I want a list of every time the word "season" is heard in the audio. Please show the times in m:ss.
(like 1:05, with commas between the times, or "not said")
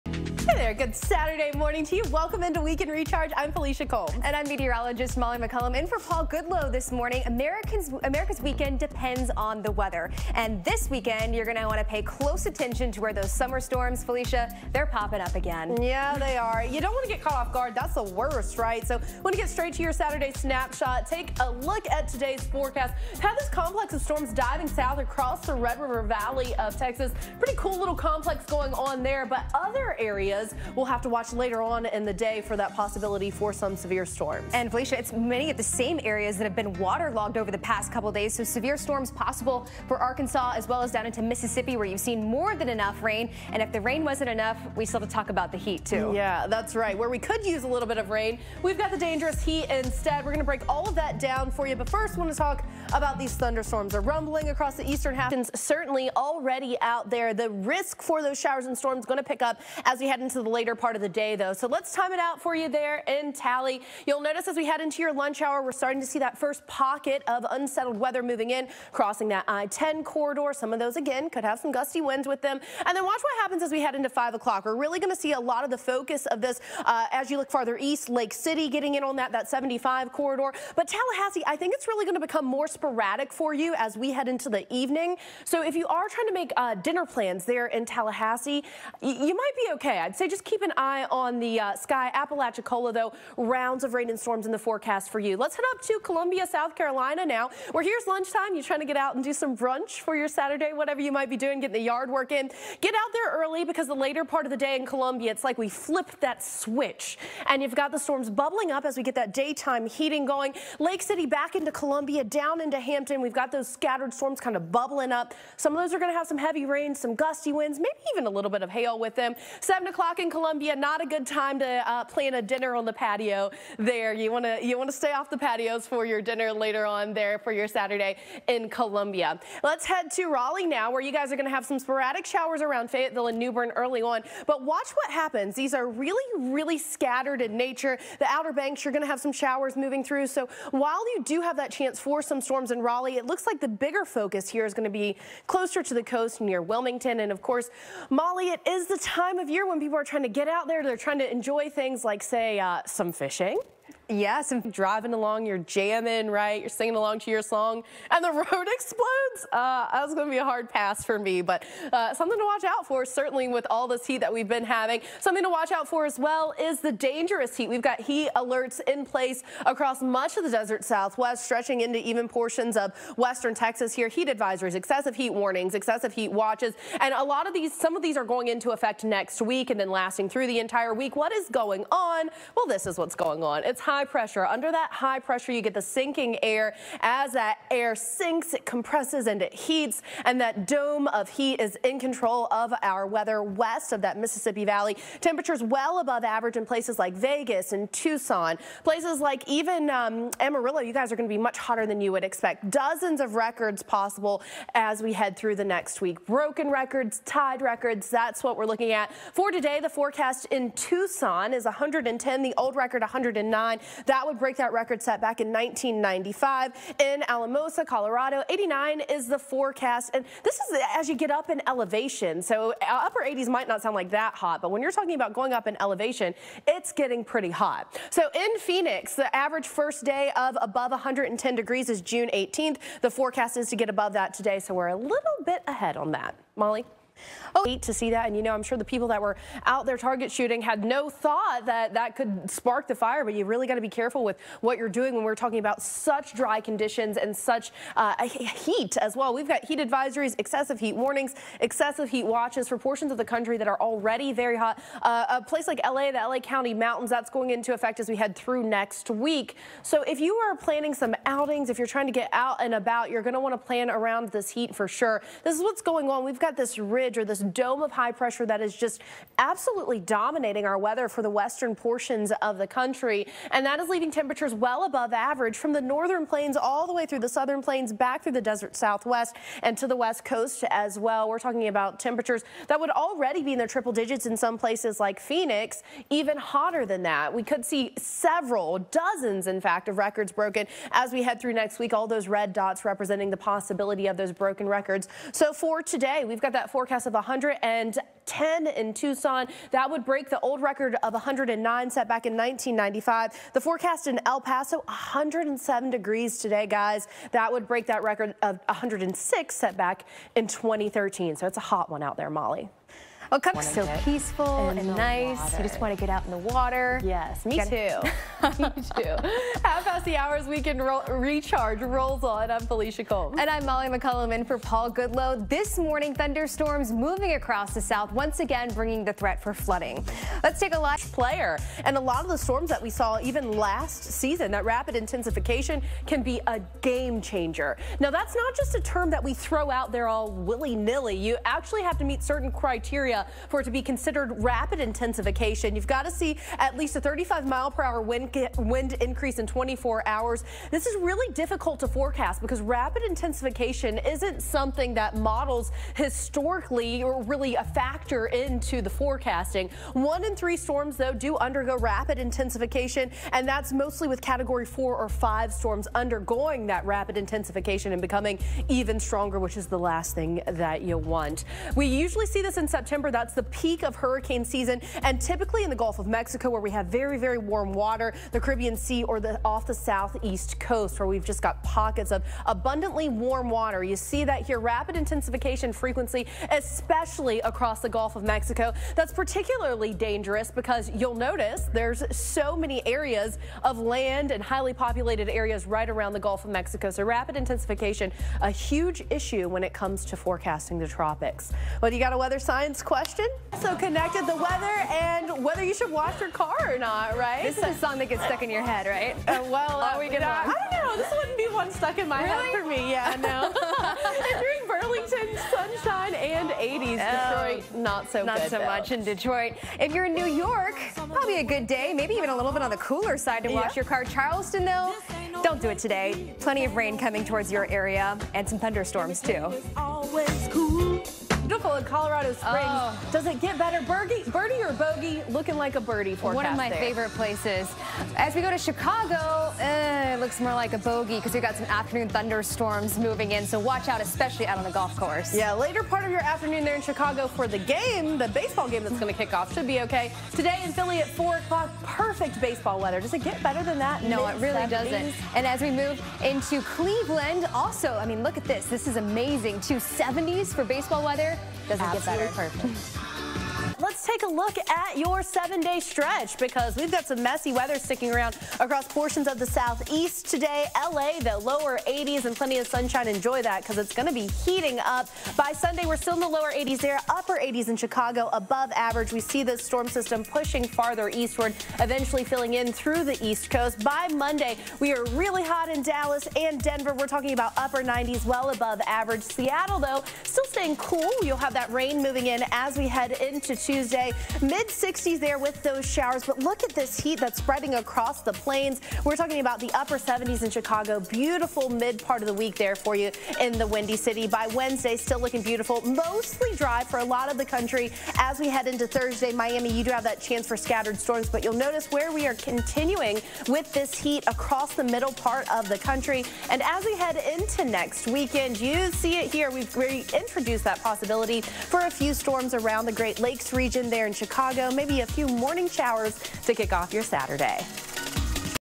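5:34, 6:14.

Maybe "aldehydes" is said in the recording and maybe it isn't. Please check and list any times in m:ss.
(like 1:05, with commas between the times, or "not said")
not said.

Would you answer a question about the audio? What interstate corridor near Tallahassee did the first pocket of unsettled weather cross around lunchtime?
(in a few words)
I-10.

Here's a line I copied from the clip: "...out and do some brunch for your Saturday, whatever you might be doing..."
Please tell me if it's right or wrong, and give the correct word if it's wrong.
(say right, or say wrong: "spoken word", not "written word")
right.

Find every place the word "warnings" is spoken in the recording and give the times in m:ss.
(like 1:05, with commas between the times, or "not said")
2:55, 4:10.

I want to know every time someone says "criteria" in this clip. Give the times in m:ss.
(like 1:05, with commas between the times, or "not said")
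5:42.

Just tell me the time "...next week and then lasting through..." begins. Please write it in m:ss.
2:59.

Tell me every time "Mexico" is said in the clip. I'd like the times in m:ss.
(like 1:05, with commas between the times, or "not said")
6:16, 6:28, 6:36.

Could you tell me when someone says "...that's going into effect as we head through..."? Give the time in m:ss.
4:17.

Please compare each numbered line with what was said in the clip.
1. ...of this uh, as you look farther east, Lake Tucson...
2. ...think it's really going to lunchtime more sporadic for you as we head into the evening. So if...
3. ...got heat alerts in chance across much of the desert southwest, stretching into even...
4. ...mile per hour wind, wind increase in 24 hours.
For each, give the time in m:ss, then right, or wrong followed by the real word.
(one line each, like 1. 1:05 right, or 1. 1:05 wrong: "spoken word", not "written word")
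1. 1:16 wrong: "City", not "Tucson"
2. 1:21 wrong: "become", not "lunchtime"
3. 2:47 wrong: "place", not "chance"
4. 5:47 right.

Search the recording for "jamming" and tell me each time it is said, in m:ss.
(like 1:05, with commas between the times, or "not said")
2:35.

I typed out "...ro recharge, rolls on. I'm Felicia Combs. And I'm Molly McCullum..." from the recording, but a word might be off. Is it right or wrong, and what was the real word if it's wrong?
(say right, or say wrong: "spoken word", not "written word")
right.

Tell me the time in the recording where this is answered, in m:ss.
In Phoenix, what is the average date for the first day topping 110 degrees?
3:52.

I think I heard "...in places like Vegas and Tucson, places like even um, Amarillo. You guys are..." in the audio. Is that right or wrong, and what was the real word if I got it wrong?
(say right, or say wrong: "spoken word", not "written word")
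right.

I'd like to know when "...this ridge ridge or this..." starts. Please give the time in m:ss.
4:26.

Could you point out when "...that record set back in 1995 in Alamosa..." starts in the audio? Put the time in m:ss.
3:34.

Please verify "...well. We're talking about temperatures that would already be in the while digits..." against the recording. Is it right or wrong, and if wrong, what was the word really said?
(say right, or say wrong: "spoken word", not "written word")
wrong: "triple", not "while".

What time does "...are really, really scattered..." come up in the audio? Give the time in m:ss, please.
2:15.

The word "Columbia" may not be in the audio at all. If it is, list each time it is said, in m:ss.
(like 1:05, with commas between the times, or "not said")
1:36, 1:44, 1:51, 2:00, 2:08.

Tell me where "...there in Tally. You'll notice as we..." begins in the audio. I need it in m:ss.
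1:02.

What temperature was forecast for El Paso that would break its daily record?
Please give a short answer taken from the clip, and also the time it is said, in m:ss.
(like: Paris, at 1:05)
107 degrees, at 5:04.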